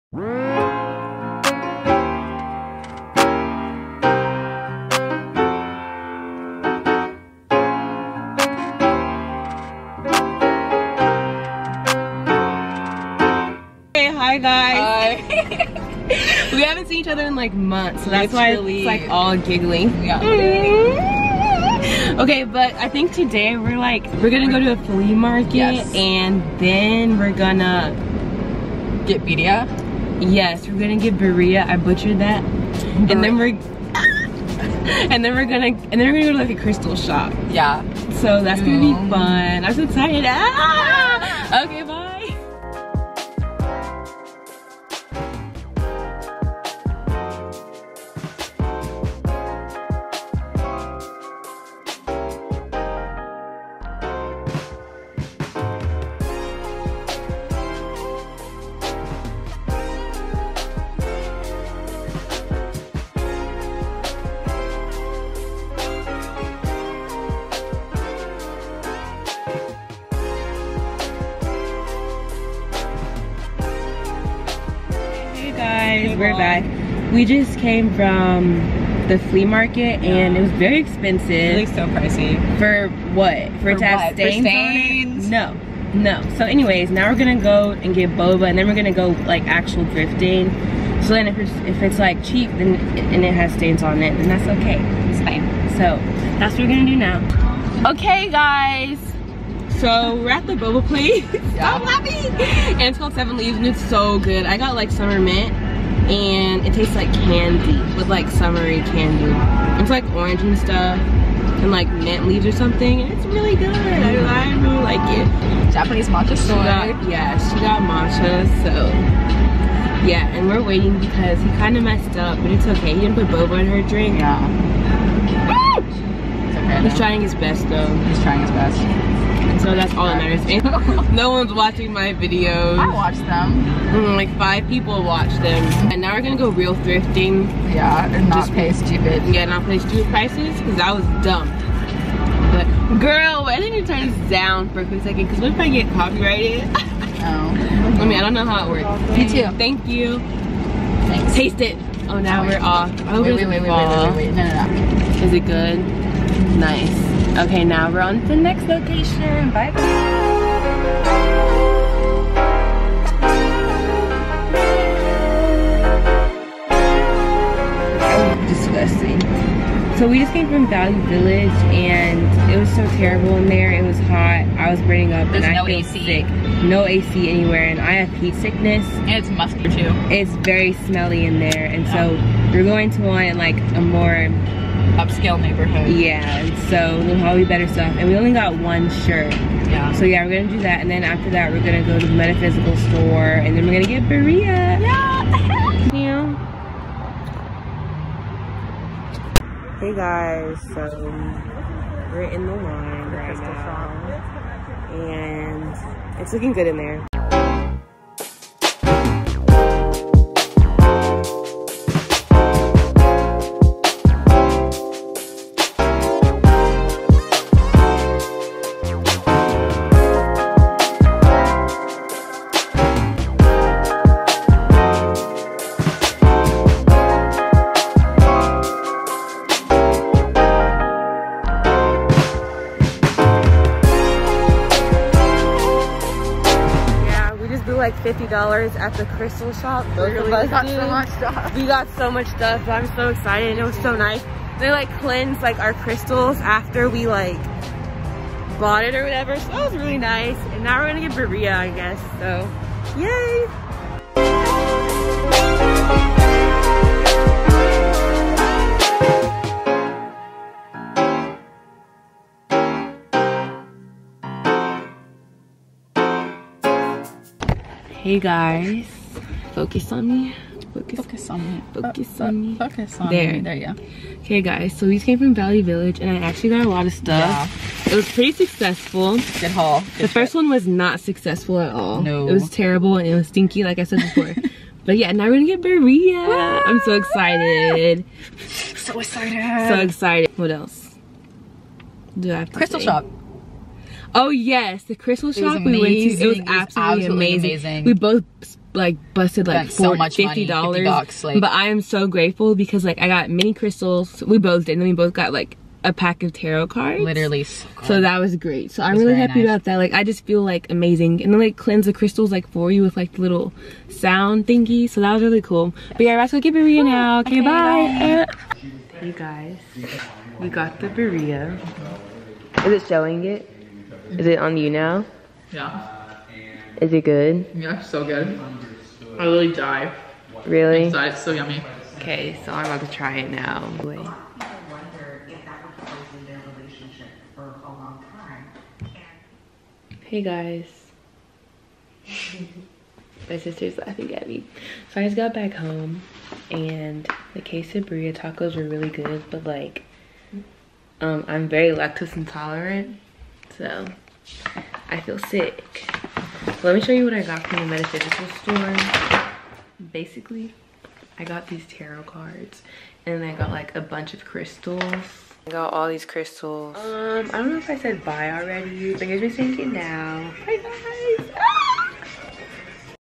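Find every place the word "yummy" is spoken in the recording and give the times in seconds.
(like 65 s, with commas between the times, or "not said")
331 s.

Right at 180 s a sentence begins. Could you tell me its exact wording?
It's very smelly in there and yeah.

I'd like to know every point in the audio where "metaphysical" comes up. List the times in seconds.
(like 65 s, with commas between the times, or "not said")
192 s, 357 s.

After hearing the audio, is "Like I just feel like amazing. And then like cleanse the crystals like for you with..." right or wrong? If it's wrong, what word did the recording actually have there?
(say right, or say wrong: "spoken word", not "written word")
right.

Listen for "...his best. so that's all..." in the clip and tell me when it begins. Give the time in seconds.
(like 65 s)
128 s.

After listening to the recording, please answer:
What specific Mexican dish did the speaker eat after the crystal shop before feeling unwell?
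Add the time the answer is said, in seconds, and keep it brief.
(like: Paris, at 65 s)
quesabirria tacos, at 347 s.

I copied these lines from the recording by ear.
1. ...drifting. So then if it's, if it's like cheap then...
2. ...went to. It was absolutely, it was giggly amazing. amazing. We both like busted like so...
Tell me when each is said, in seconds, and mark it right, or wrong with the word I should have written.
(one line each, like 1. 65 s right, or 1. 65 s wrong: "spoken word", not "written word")
1. 89 s right
2. 295 s wrong: "absolutely", not "giggly".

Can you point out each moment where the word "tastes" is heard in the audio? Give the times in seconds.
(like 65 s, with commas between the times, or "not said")
106 s, 151 s.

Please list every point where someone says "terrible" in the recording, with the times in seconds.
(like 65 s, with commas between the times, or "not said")
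172 s, 282 s.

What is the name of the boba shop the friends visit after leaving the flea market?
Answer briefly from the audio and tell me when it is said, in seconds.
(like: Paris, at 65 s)
Seven Leaves, at 103 s.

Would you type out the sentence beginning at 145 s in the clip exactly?
Because what if I get copyrighted?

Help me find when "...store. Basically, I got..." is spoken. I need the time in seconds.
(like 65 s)
358 s.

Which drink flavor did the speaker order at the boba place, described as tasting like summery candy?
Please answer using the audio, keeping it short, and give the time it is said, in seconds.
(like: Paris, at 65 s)
summer mint, at 104 s.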